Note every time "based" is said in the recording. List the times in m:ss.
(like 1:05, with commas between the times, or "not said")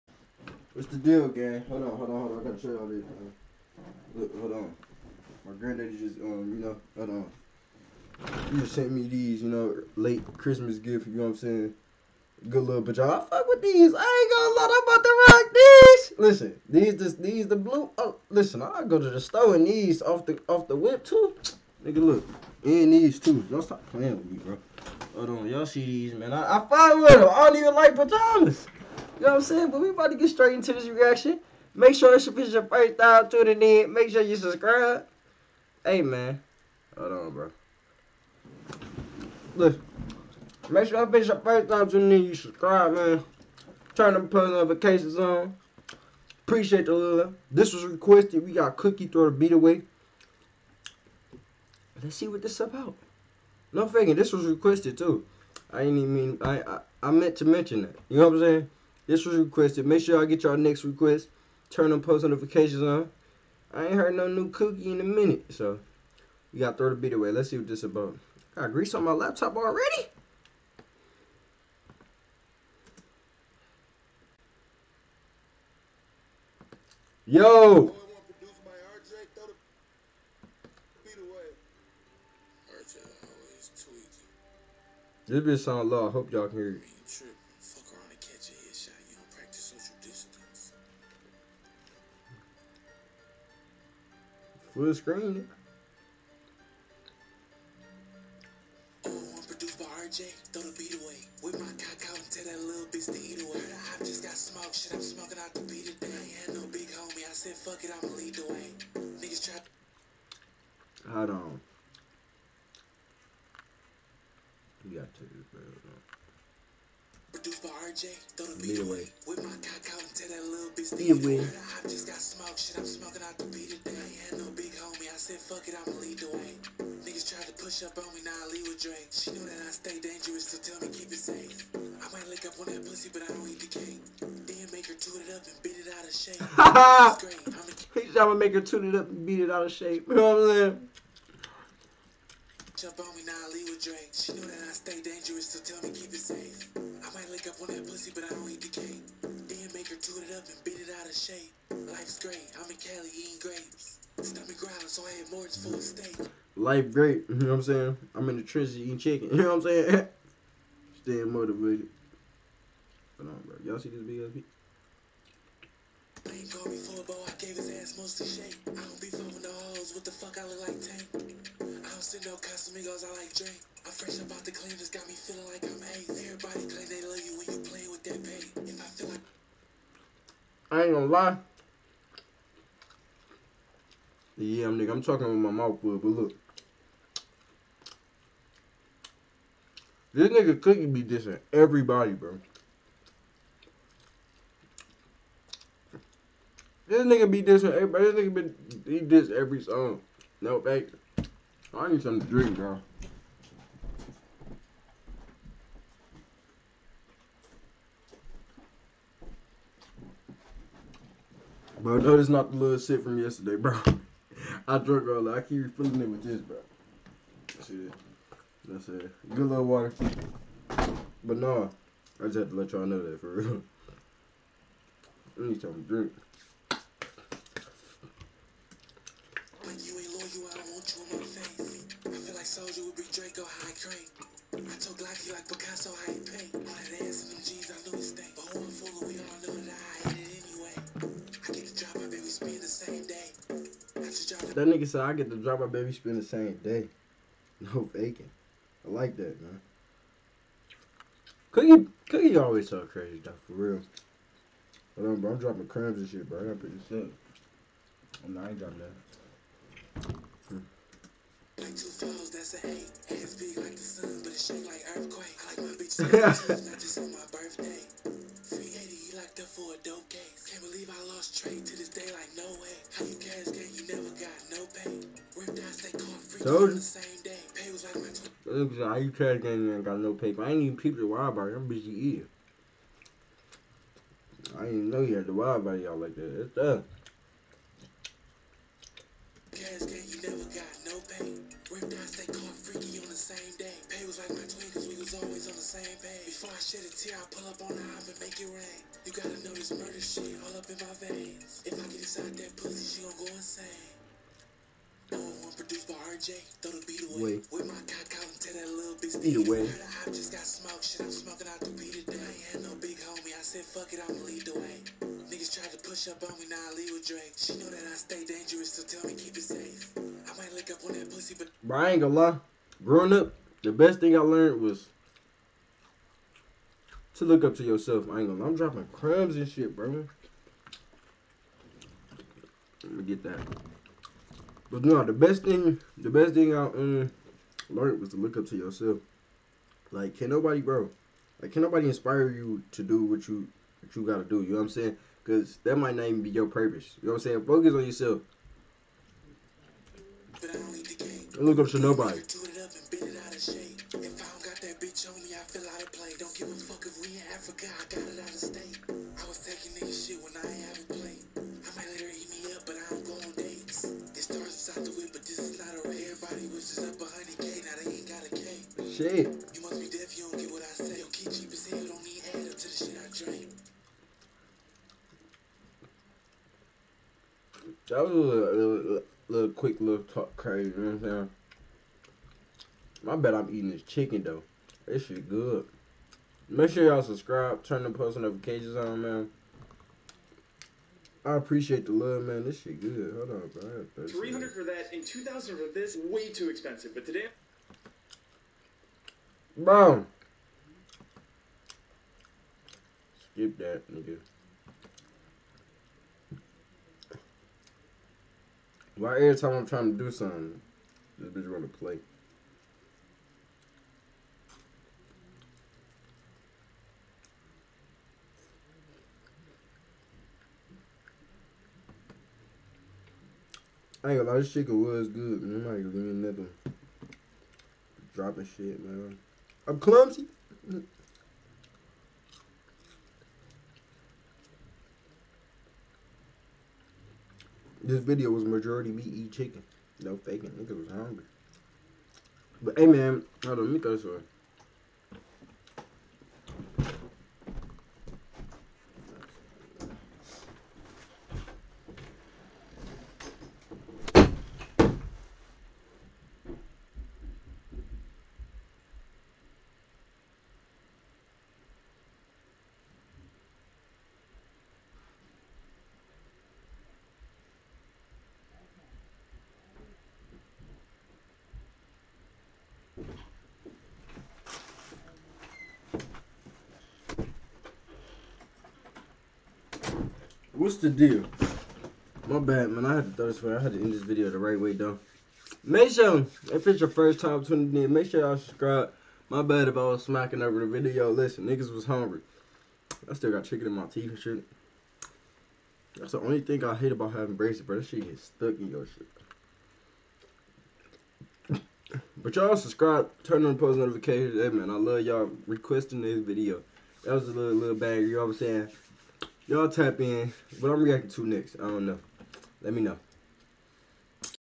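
not said.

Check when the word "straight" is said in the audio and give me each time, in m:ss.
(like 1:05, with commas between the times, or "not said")
0:30.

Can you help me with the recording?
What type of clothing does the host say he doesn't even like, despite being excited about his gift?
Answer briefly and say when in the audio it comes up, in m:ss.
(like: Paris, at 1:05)
pajamas, at 0:27.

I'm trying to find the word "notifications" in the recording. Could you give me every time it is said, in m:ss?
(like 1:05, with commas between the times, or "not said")
0:44, 1:02, 6:28, 8:23.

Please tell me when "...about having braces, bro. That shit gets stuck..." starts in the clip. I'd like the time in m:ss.
8:16.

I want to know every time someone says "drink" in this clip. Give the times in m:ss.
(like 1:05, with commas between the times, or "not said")
2:53, 3:22, 3:45.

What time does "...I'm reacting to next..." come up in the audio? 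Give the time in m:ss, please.
8:30.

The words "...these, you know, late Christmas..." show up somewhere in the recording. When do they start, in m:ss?
0:09.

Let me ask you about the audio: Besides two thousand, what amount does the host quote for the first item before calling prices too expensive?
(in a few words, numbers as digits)
300.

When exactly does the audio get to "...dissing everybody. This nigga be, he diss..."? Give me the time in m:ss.
3:17.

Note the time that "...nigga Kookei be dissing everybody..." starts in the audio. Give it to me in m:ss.
3:10.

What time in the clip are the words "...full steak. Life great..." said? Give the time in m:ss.
2:35.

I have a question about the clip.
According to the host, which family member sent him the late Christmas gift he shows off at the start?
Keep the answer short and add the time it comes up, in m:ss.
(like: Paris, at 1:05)
granddaddy, at 0:05.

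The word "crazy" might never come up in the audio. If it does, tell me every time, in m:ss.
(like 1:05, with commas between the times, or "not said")
4:12, 6:20.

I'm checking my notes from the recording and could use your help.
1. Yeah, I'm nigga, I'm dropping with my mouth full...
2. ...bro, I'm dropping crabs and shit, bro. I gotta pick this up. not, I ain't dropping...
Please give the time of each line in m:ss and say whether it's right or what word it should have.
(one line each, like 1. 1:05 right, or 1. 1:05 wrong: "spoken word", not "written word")
1. 3:04 wrong: "talking", not "dropping"
2. 4:15 right.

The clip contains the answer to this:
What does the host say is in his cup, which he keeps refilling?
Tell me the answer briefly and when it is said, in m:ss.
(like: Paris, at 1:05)
water, at 3:39.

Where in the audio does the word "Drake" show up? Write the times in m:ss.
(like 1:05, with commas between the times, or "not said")
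2:08, 2:23, 5:17.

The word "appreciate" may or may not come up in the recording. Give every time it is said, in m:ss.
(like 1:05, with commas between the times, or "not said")
0:46, 6:31.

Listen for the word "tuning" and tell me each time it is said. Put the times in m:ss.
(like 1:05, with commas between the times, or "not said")
0:33, 0:41, 8:07.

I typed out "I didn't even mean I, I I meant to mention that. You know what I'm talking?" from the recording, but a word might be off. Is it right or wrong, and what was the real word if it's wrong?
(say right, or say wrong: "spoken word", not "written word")
wrong: "saying", not "talking".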